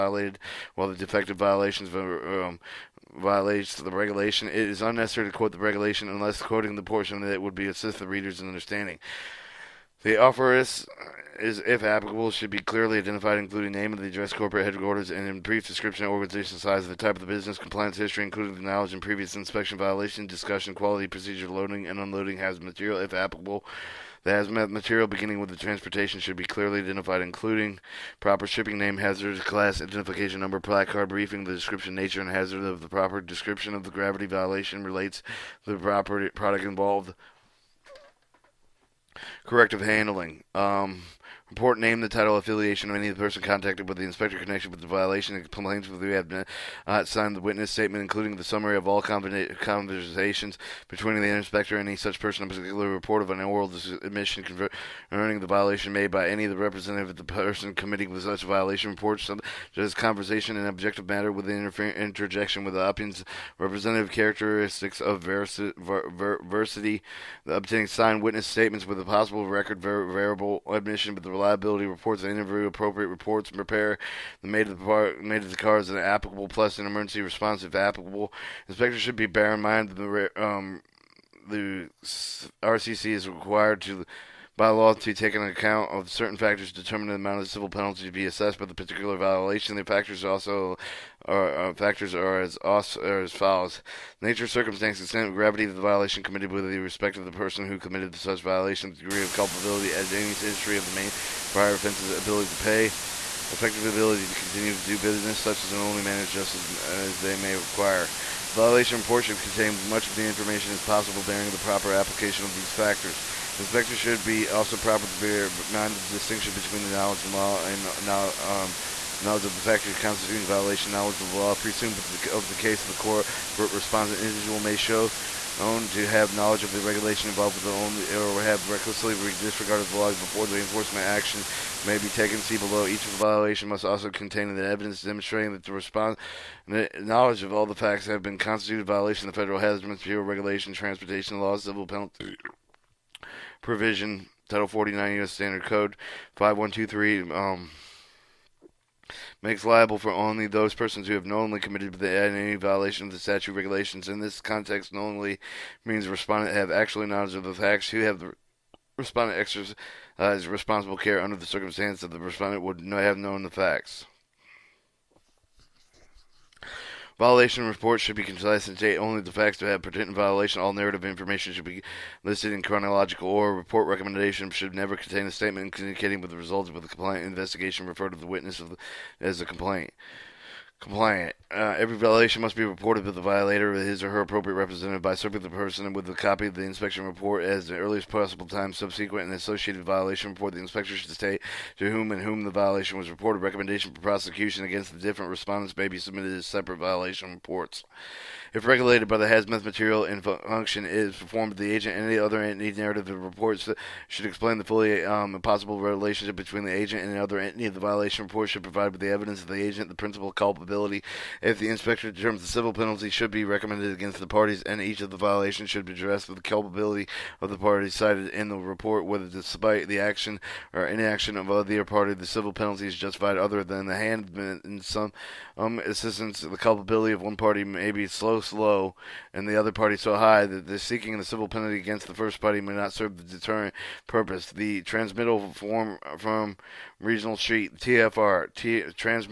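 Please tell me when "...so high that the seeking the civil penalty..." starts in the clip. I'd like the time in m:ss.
3:49.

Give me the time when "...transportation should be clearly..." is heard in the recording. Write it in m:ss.
0:25.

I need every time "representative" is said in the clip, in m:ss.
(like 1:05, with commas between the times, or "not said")
0:56, 1:03, 3:04.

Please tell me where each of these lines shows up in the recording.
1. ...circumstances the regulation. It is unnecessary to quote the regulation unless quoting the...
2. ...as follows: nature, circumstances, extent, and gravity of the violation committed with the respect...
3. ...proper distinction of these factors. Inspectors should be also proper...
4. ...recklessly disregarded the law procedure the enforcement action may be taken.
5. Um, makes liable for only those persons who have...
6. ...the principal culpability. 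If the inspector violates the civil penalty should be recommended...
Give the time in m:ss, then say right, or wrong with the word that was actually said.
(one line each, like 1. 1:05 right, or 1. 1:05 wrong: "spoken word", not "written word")
1. 0:03 wrong: "violates", not "circumstances"
2. 1:33 right
3. 1:51 wrong: "application", not "distinction"
4. 2:08 wrong: "before", not "procedure"
5. 2:27 right
6. 3:29 wrong: "determines", not "violates".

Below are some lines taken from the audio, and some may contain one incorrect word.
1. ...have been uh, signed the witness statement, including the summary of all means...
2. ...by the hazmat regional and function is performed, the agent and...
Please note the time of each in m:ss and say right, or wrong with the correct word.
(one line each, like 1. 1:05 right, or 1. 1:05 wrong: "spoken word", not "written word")
1. 0:46 wrong: "conversations", not "means"
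2. 3:19 wrong: "material", not "regional".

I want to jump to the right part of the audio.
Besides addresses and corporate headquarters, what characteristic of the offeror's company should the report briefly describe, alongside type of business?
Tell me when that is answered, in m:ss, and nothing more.
0:16.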